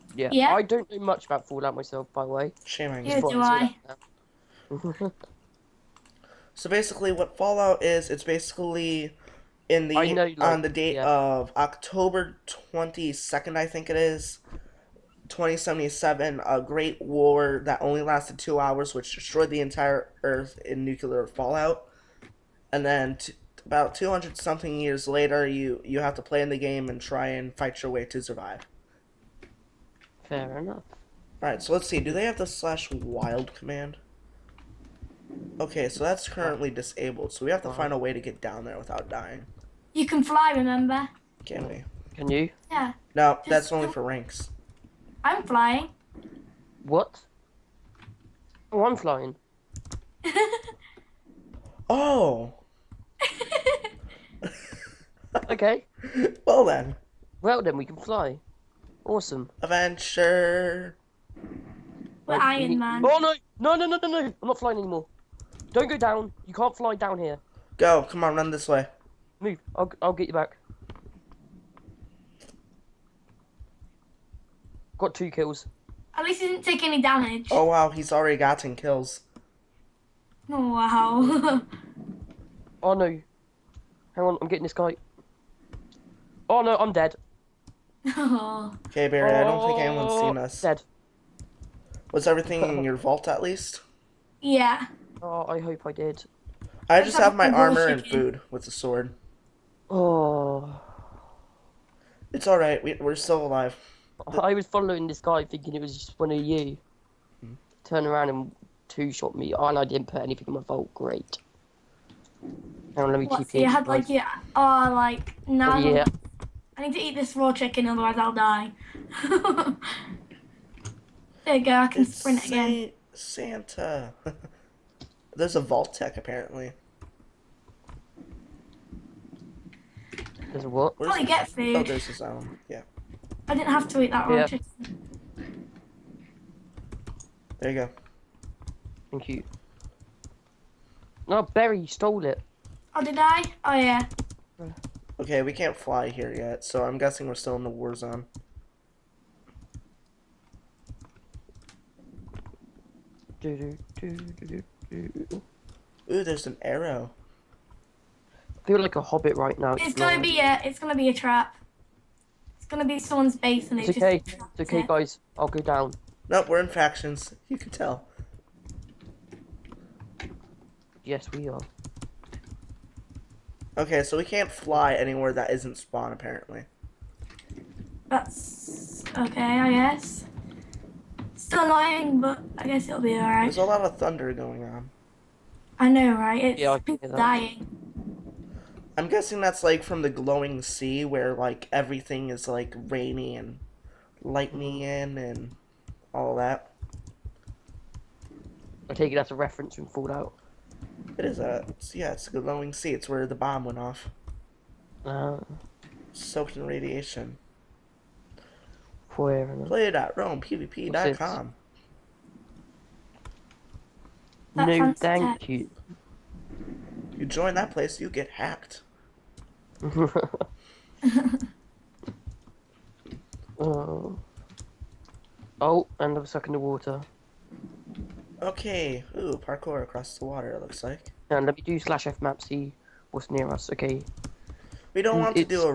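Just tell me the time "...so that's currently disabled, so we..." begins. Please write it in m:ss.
0:35.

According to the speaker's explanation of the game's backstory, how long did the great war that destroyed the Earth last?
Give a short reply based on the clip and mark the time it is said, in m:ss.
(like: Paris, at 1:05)
2 hours, at 0:18.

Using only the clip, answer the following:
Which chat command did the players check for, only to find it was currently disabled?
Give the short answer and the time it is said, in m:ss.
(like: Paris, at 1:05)
slash wild, at 0:32.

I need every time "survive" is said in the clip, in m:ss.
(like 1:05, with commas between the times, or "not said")
0:28.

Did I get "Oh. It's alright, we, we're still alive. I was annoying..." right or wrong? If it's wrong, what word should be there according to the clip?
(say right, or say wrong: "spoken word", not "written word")
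wrong: "following", not "annoying".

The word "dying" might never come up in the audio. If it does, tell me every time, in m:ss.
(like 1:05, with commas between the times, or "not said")
0:39, 3:07.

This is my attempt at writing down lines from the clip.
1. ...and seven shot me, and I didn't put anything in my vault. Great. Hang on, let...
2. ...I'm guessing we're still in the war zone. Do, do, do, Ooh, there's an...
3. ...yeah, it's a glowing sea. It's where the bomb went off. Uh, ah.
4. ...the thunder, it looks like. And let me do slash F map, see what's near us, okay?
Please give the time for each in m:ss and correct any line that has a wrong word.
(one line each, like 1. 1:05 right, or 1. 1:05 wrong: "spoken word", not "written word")
1. 1:48 wrong: "two", not "seven"
2. 2:26 right
3. 3:21 right
4. 3:50 wrong: "water", not "thunder".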